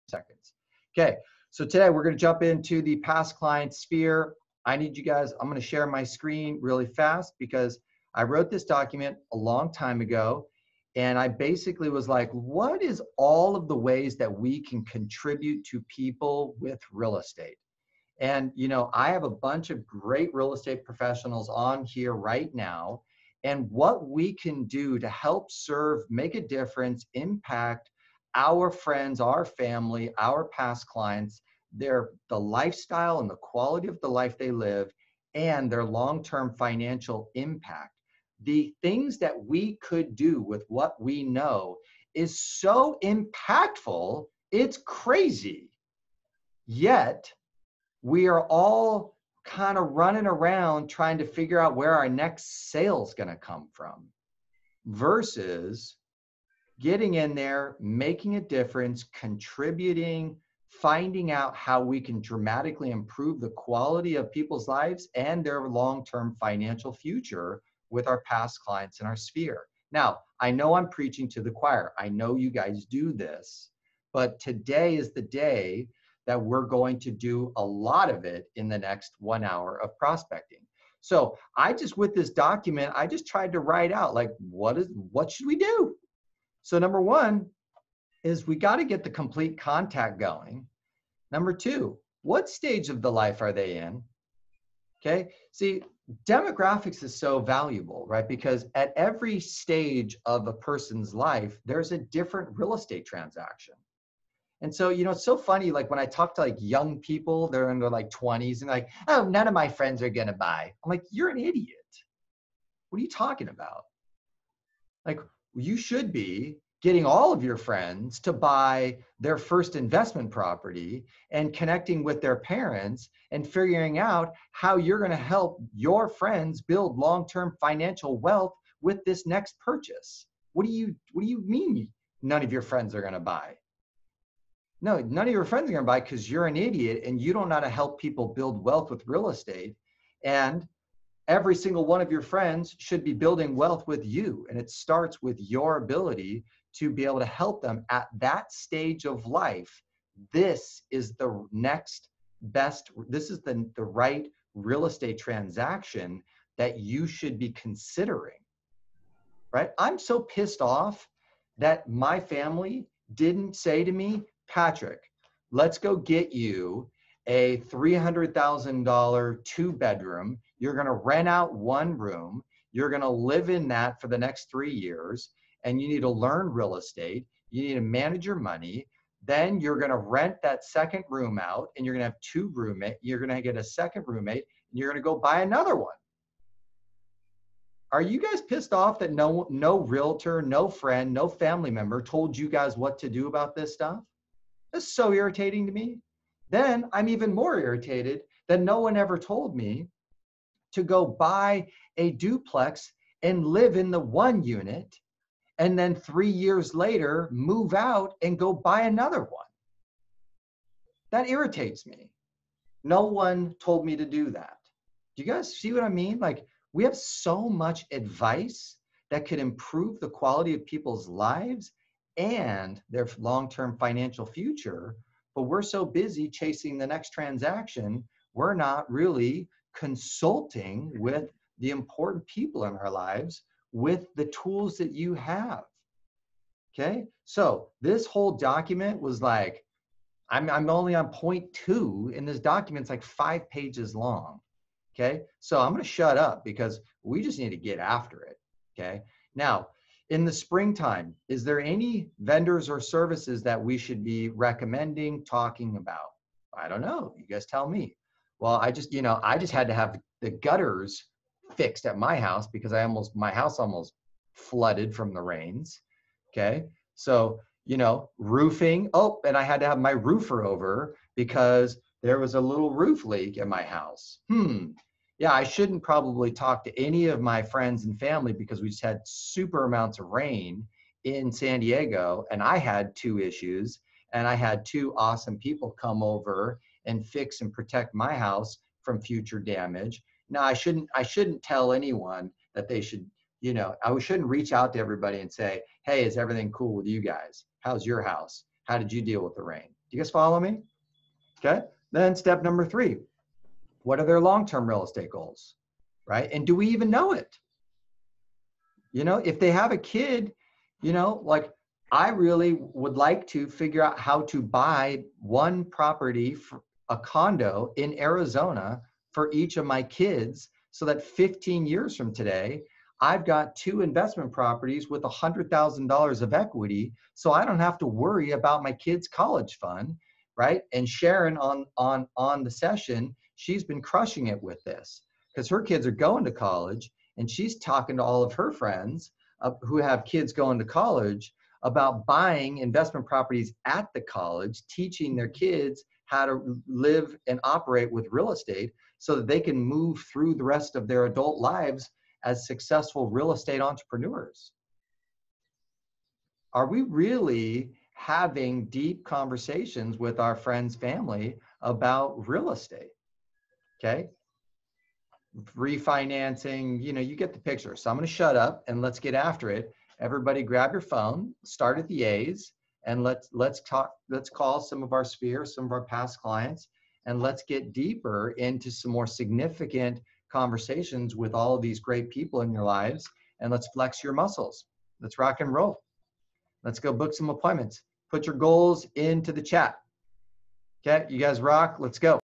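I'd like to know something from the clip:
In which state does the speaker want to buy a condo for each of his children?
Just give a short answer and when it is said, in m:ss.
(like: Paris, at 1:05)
Arizona, at 5:17.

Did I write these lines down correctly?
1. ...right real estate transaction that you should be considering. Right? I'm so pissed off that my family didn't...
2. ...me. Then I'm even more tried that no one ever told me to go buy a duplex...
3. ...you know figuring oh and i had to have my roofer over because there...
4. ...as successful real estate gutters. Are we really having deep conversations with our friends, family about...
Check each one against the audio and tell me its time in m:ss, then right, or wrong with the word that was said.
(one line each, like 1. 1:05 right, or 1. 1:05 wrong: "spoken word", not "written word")
1. 2:33 right
2. 3:15 wrong: "irritated", not "tried"
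3. 4:27 wrong: "roofing", not "figuring"
4. 5:52 wrong: "entrepreneurs", not "gutters".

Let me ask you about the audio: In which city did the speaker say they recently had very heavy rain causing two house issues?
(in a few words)
San Diego.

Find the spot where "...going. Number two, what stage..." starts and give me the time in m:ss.
1:30.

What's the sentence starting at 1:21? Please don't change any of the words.
So I just with this document, I just tried to write out like what is what should we do?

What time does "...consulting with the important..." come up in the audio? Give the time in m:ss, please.
3:49.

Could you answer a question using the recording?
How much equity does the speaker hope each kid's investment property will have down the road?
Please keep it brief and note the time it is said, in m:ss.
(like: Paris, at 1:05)
$100,000, at 5:25.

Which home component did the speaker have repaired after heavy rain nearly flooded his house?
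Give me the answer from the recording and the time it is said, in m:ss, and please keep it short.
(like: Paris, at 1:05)
gutters, at 4:20.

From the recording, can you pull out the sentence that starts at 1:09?
Now, I know I'm preaching to the choir.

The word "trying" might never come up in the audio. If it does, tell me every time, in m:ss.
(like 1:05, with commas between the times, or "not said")
0:50.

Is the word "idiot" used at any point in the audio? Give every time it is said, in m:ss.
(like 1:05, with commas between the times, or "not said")
1:51, 2:16.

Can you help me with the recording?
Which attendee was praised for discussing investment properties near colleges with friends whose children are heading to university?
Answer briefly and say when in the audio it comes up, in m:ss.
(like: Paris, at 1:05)
Sharon, at 5:30.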